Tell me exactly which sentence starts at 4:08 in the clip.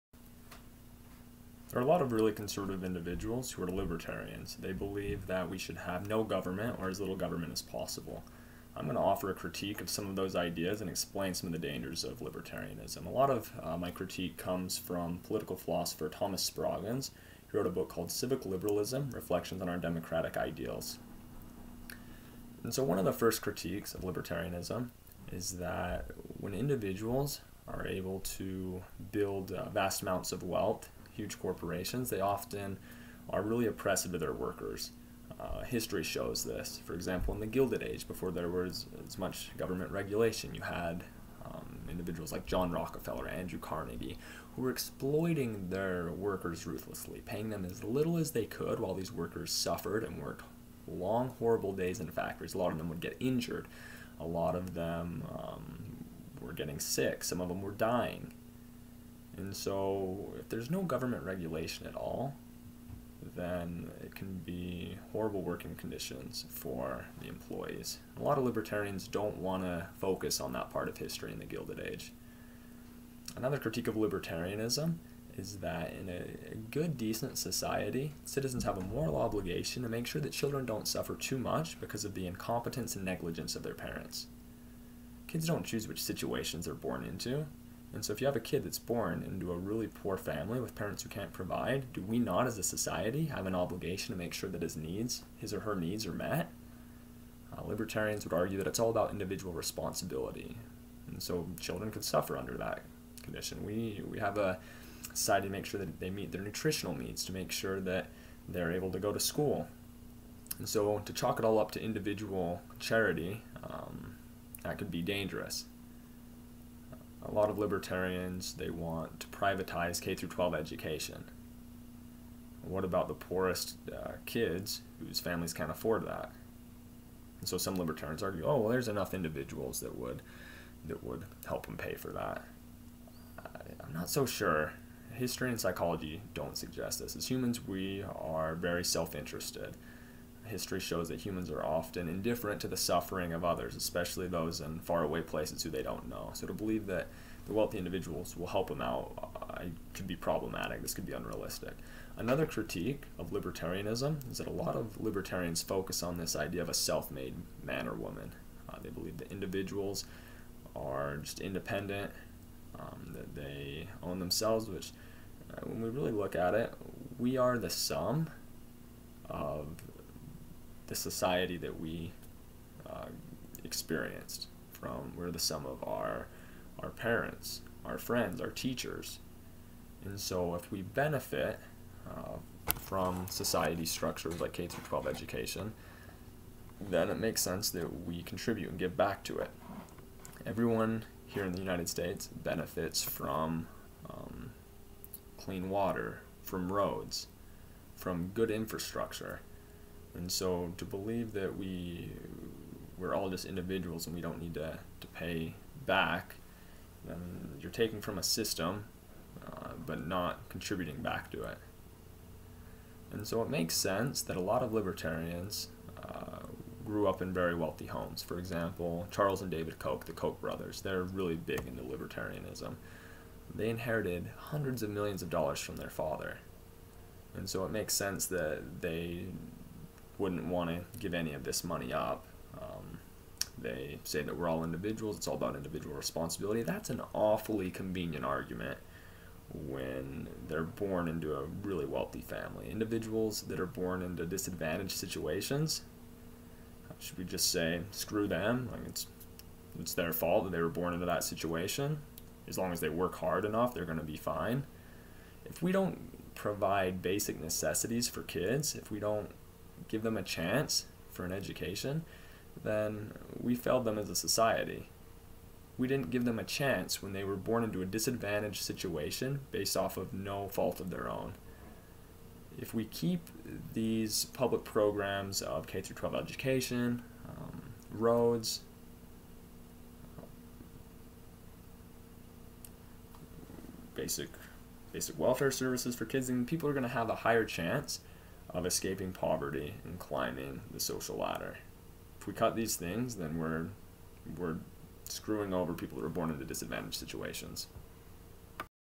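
Like it's it's their fault that they were born into that situation.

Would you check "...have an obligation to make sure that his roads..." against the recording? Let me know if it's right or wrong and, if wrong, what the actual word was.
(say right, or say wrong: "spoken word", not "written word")
wrong: "needs", not "roads".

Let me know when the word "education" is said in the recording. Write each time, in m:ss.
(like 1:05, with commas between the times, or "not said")
2:00, 3:05, 4:21, 4:36.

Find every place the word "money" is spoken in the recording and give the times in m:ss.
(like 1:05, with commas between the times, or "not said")
3:51.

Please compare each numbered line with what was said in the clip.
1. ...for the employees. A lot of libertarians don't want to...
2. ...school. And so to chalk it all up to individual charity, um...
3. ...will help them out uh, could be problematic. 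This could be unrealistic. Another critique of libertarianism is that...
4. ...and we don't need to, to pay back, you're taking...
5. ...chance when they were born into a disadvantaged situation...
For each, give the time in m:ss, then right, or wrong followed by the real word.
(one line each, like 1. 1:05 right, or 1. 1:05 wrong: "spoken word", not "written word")
1. 1:06 right
2. 1:49 right
3. 2:28 right
4. 3:24 right
5. 4:26 right.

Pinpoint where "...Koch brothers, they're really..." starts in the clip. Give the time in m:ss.
3:40.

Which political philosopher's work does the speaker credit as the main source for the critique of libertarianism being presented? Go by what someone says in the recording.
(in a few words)
Thomas Spragens.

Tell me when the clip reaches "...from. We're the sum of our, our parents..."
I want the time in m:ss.
2:54.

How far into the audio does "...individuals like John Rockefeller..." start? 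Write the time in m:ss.
0:41.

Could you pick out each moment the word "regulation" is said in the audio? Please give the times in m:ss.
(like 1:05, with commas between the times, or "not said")
0:39, 1:01.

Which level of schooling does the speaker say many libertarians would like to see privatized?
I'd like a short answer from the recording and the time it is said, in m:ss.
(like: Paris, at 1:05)
K through 12, at 2:00.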